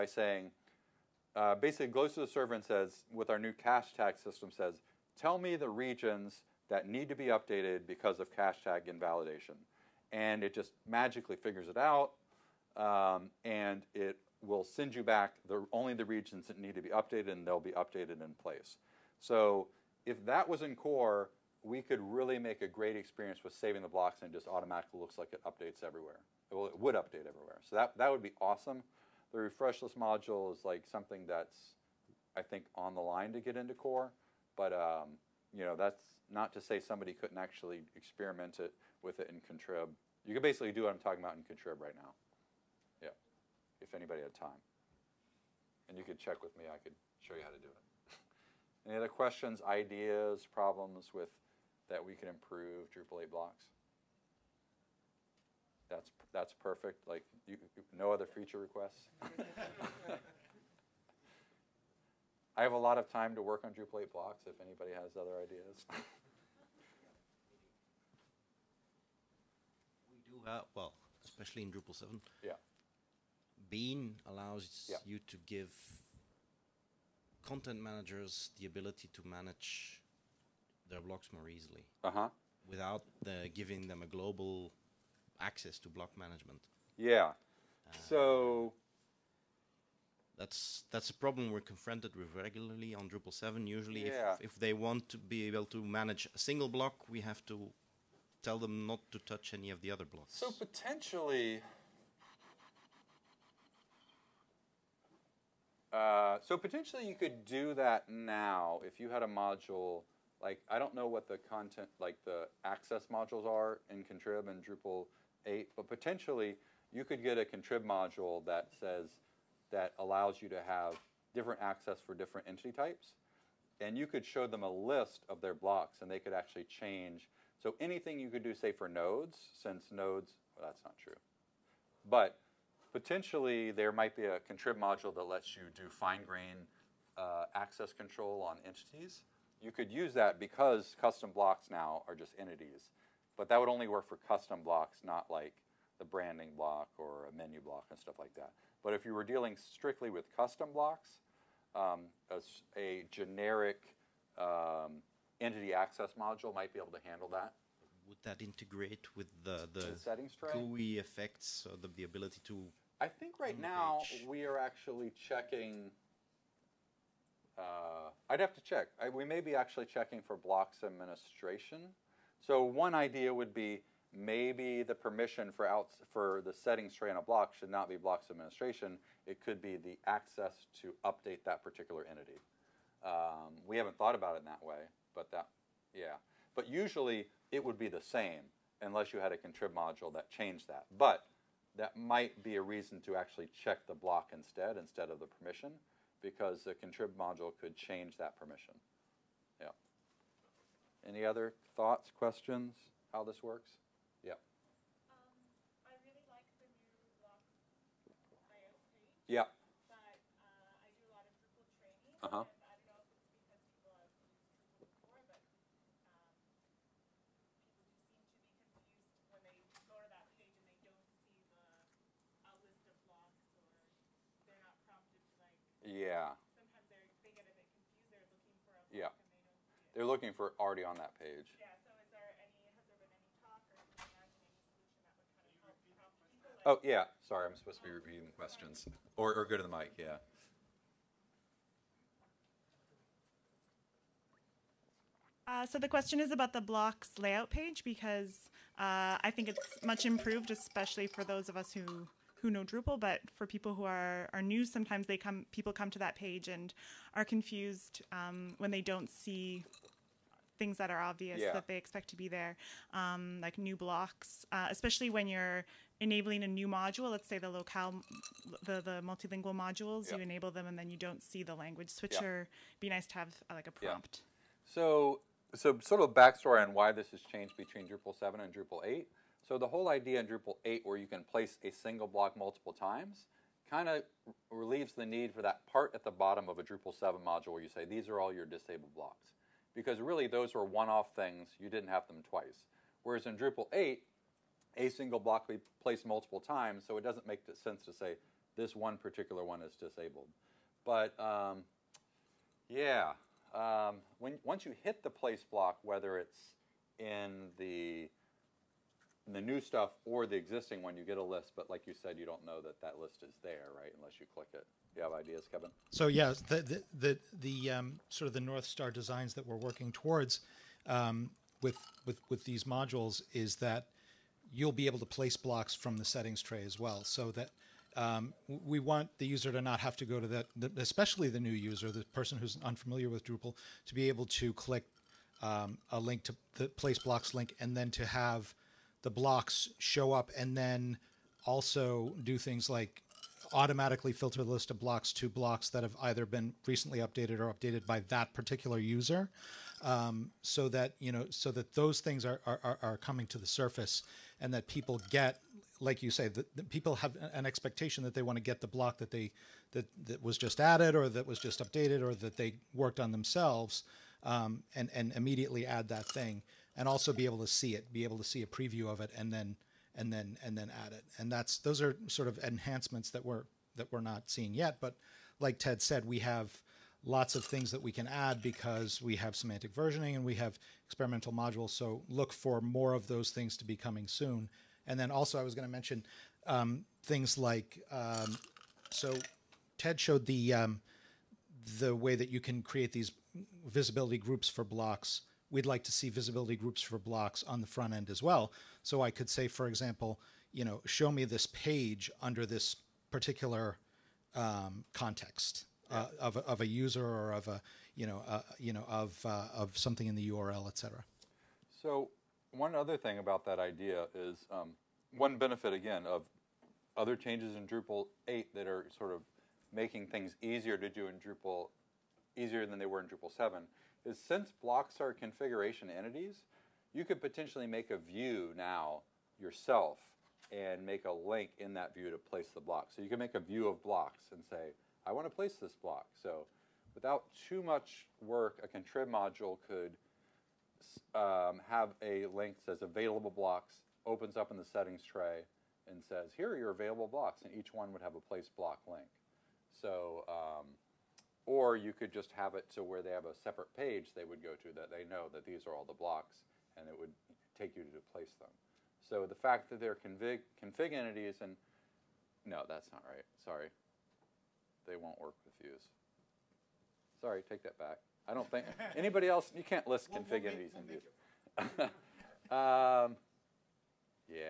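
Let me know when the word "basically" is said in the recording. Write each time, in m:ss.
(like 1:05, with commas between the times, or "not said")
0:01, 0:40.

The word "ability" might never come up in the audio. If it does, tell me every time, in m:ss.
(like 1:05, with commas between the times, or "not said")
1:18, 2:42.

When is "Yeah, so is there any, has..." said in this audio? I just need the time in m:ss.
3:51.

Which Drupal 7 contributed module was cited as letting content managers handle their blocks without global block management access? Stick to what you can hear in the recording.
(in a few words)
Bean.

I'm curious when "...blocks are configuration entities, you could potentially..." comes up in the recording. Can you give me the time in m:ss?
7:04.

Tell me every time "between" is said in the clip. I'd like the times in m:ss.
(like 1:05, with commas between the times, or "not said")
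4:37.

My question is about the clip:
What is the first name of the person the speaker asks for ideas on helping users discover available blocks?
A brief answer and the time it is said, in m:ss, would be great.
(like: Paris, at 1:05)
Kevin, at 5:15.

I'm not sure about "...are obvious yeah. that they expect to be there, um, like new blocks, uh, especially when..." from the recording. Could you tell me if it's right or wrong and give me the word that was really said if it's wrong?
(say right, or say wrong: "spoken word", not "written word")
right.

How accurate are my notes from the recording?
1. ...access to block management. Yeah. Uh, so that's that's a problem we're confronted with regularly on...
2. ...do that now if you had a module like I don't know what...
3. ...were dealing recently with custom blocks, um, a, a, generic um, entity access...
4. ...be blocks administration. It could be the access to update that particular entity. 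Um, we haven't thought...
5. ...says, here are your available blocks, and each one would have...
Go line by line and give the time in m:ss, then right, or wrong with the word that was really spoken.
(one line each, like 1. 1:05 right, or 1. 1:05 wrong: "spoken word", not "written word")
1. 1:25 right
2. 1:47 right
3. 2:29 wrong: "strictly", not "recently"
4. 2:57 right
5. 7:26 right.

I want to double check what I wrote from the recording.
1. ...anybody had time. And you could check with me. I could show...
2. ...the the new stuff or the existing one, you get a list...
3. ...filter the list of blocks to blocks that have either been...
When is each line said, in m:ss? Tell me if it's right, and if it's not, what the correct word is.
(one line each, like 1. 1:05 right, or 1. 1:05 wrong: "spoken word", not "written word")
1. 0:43 right
2. 5:07 right
3. 5:44 right.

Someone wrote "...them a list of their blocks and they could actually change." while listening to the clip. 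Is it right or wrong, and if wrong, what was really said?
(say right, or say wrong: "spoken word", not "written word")
right.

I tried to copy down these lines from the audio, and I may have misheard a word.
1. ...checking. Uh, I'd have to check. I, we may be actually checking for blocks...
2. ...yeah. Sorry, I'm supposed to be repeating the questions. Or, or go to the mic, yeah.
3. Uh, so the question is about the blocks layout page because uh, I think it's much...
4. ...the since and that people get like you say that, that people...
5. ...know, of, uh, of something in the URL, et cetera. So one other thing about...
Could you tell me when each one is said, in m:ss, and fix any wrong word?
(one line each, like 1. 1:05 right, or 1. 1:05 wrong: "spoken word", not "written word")
1. 2:45 right
2. 3:56 right
3. 4:05 right
4. 5:53 wrong: "surface", not "since"
5. 6:48 right.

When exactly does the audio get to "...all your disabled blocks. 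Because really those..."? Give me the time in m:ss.
4:48.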